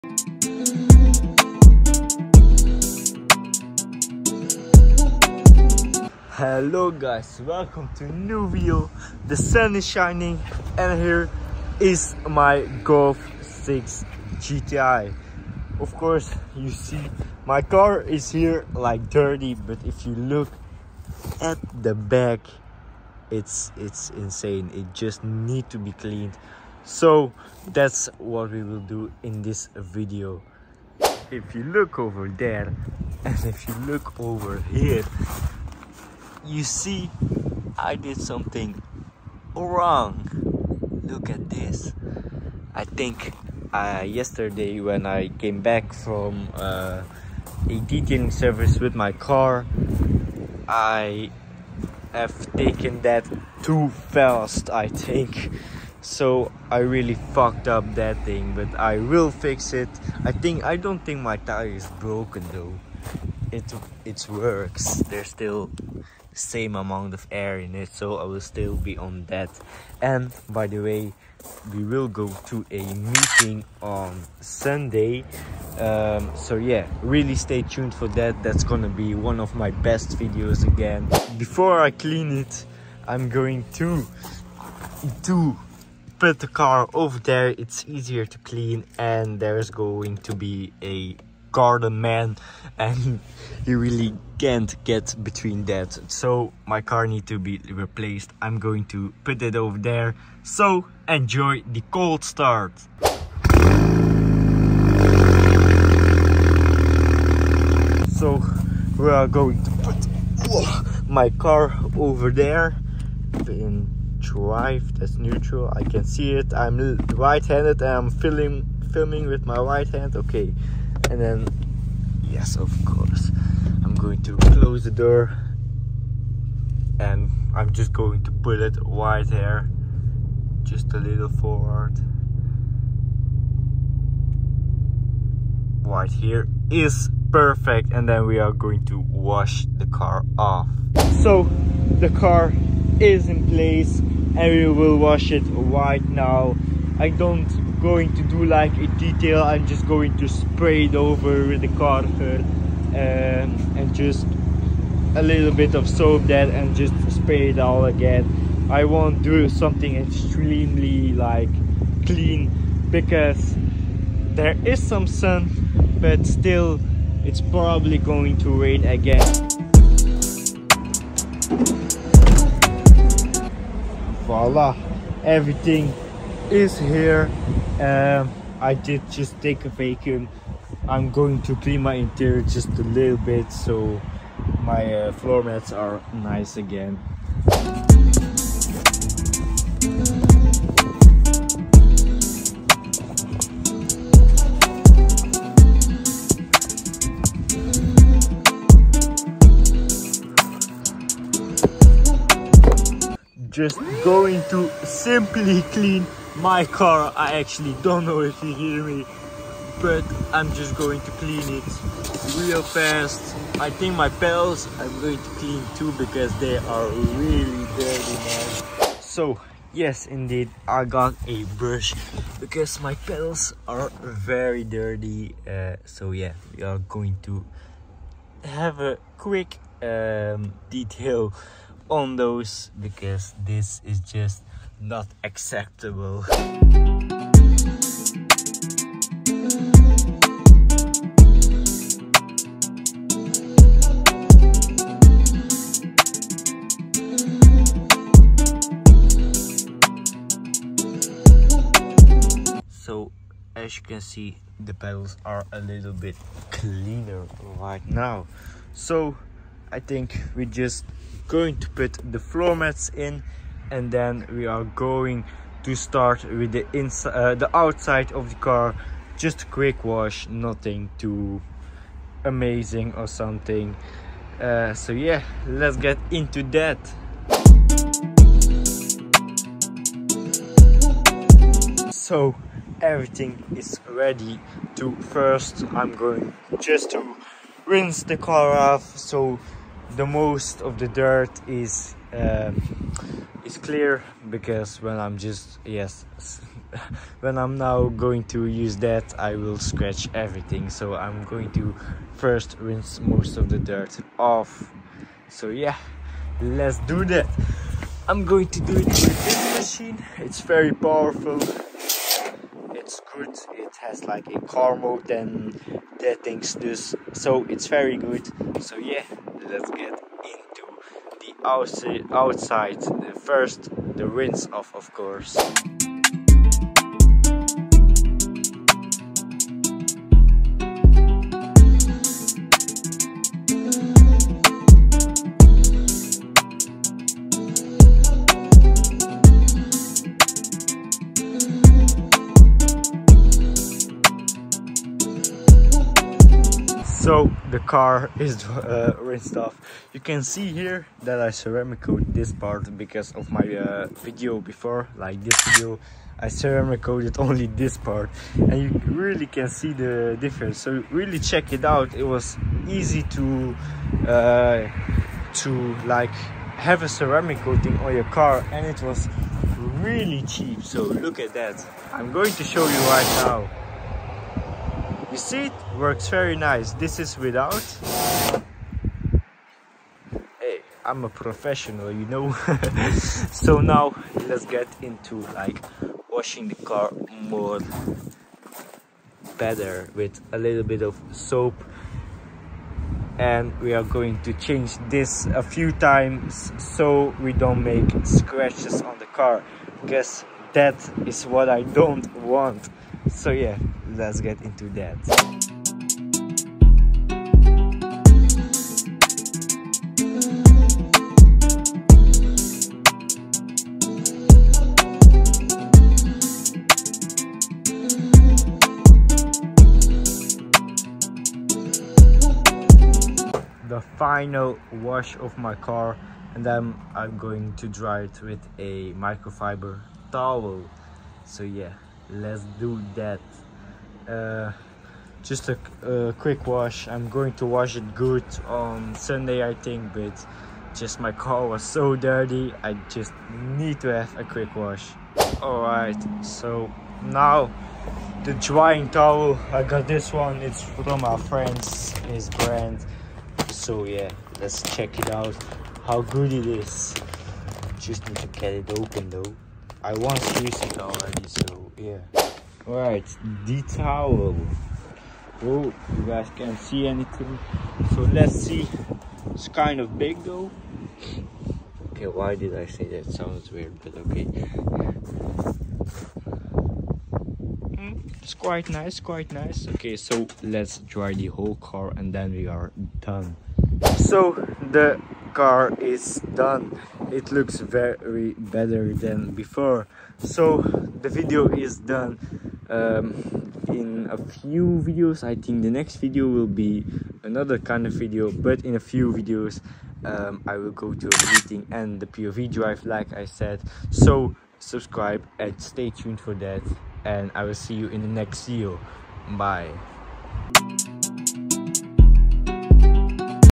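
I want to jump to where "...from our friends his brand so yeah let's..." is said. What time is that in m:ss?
7:30.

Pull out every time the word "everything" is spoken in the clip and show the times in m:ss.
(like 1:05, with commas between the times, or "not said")
2:55, 4:42, 5:00.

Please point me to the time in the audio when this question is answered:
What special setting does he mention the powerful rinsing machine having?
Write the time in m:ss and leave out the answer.
5:14.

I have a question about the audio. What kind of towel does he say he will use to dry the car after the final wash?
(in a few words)
Microfiber towel.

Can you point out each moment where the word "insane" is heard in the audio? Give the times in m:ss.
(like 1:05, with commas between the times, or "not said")
0:24.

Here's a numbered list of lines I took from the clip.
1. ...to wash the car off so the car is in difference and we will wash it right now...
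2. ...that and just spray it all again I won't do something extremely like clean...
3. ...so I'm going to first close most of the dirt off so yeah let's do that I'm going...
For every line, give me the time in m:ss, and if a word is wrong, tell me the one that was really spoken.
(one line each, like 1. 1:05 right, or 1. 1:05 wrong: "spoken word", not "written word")
1. 2:18 wrong: "place", not "difference"
2. 2:36 right
3. 5:00 wrong: "rinse", not "close".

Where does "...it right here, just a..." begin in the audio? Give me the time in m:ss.
2:08.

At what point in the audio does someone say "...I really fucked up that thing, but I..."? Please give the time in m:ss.
0:56.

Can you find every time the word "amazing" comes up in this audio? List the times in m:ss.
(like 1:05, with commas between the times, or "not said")
4:32.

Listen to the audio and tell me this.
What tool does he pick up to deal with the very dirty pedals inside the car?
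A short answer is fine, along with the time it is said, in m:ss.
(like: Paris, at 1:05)
A brush, at 3:41.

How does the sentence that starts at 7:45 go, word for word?
Oh, you guys can't see anything.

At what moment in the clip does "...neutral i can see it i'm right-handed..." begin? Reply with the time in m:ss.
1:55.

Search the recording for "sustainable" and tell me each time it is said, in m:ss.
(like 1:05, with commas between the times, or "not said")
not said.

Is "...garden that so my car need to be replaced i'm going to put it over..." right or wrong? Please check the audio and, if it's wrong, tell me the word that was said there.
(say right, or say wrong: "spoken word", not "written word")
wrong: "between", not "garden".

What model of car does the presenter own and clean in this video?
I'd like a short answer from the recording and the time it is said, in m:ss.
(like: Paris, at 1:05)
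Golf 6 GTI, at 0:12.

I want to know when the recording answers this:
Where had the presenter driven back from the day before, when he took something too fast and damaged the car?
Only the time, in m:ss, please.
0:47.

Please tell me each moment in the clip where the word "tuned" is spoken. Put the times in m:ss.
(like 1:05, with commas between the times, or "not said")
1:17, 8:25.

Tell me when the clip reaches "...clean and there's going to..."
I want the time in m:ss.
1:28.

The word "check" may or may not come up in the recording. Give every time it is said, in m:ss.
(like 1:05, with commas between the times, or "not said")
6:01, 7:34.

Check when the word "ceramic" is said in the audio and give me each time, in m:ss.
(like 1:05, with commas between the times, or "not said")
5:51, 5:56, 6:06.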